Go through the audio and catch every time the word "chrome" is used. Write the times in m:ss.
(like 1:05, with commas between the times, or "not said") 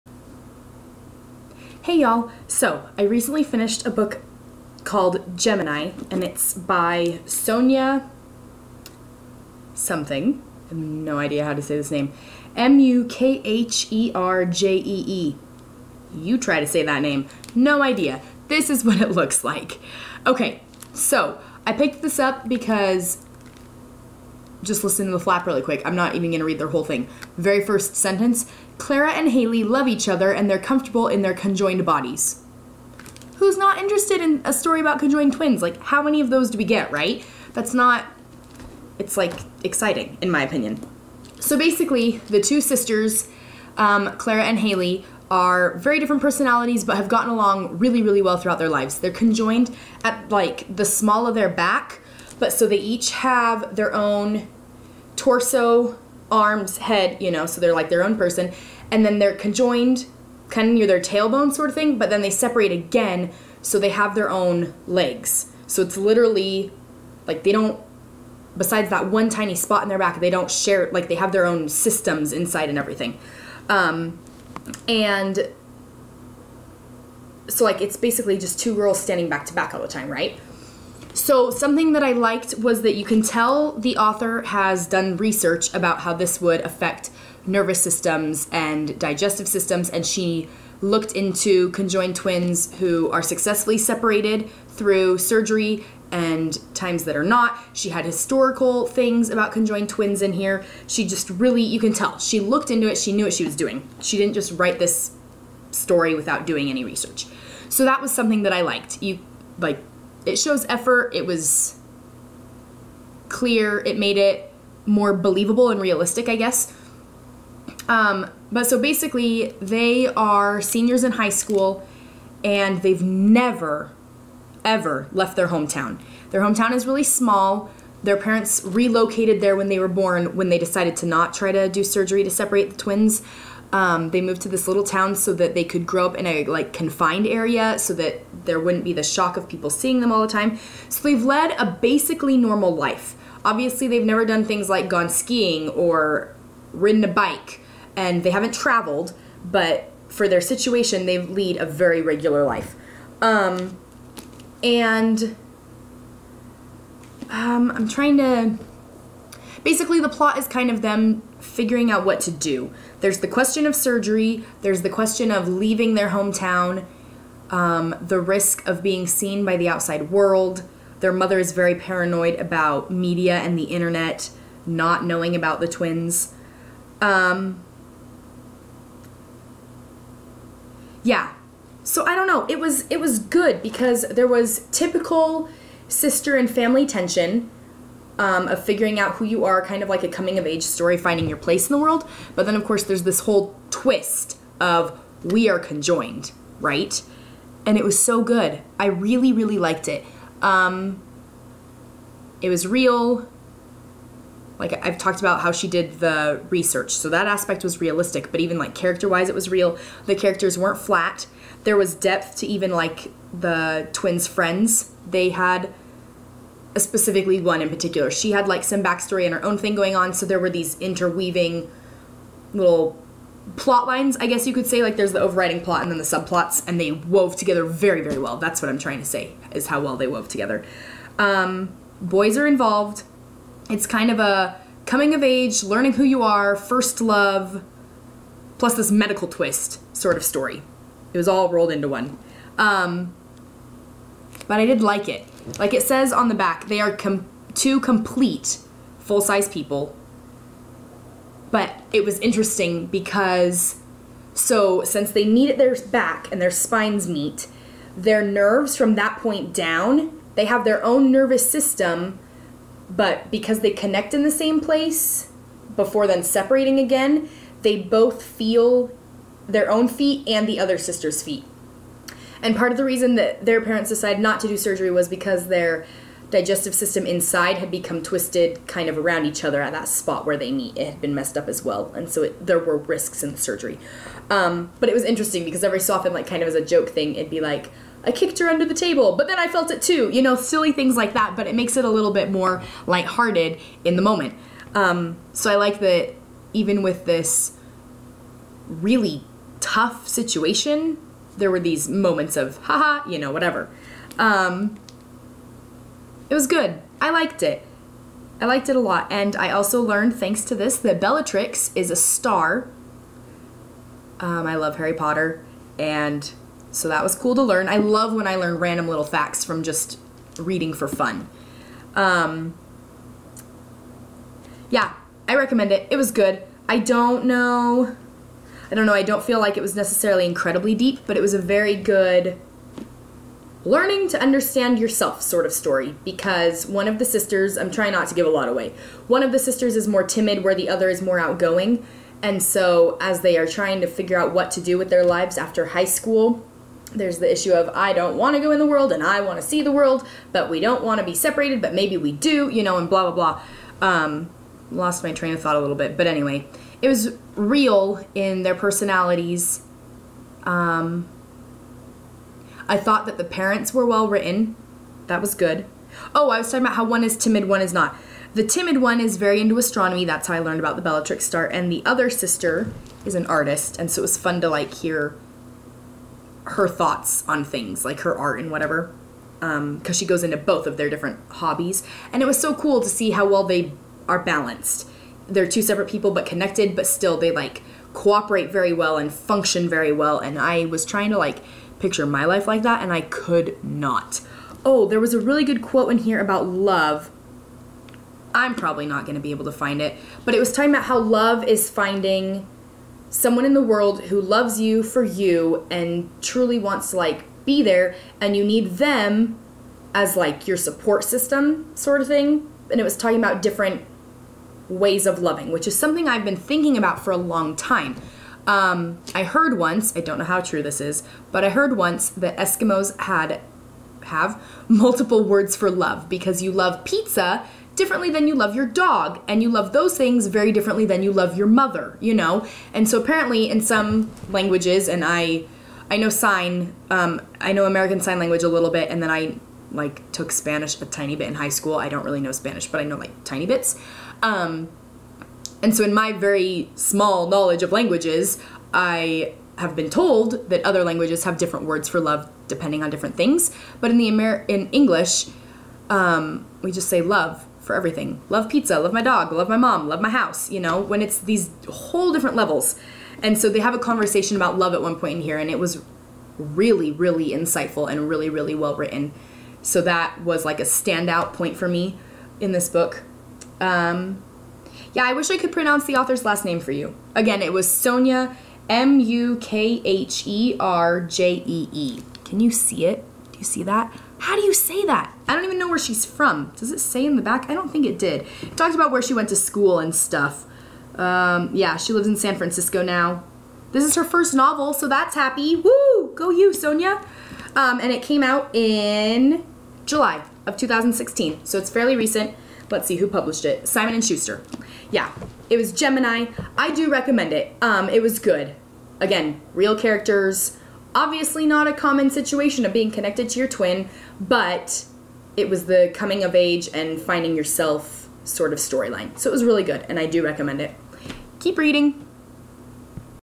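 not said.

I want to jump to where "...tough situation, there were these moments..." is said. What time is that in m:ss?
4:59.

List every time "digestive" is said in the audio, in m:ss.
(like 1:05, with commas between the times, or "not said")
1:28, 4:36.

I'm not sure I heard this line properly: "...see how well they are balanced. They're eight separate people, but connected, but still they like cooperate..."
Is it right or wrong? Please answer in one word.
wrong.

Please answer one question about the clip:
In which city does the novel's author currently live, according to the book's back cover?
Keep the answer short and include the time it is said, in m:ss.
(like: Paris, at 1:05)
San Francisco, at 8:12.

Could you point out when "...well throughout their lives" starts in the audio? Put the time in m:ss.
0:48.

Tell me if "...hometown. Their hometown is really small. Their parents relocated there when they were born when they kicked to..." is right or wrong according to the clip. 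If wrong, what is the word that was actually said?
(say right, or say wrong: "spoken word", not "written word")
wrong: "decided", not "kicked".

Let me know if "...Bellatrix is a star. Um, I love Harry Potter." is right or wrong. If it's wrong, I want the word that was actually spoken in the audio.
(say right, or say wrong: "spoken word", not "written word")
right.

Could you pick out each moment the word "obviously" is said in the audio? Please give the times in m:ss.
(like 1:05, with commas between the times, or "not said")
2:23, 8:30.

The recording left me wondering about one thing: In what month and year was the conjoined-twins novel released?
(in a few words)
July 2016.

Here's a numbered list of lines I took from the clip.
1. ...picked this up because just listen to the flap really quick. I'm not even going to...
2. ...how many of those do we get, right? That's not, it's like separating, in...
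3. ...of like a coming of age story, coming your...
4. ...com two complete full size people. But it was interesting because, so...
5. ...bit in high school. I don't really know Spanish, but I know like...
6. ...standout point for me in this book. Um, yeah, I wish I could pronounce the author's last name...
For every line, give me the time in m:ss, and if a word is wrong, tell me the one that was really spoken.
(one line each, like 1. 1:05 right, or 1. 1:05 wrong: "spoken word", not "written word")
1. 0:21 right
2. 0:35 wrong: "exciting", not "separating"
3. 3:09 wrong: "finding", not "coming"
4. 4:06 right
5. 7:21 right
6. 7:50 right.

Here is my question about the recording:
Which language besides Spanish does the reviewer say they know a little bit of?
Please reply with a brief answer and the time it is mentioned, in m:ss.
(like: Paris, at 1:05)
American Sign Language, at 7:17.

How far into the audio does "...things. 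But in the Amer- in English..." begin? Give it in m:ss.
7:33.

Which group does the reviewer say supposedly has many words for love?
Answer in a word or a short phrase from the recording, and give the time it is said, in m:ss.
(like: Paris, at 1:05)
Eskimos, at 7:02.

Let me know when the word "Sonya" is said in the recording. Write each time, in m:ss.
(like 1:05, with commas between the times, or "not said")
0:07, 7:57, 8:16.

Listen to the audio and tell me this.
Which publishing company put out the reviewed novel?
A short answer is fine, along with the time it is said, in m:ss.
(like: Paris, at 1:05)
Simon and Schuster, at 8:23.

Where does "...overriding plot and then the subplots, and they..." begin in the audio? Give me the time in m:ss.
3:45.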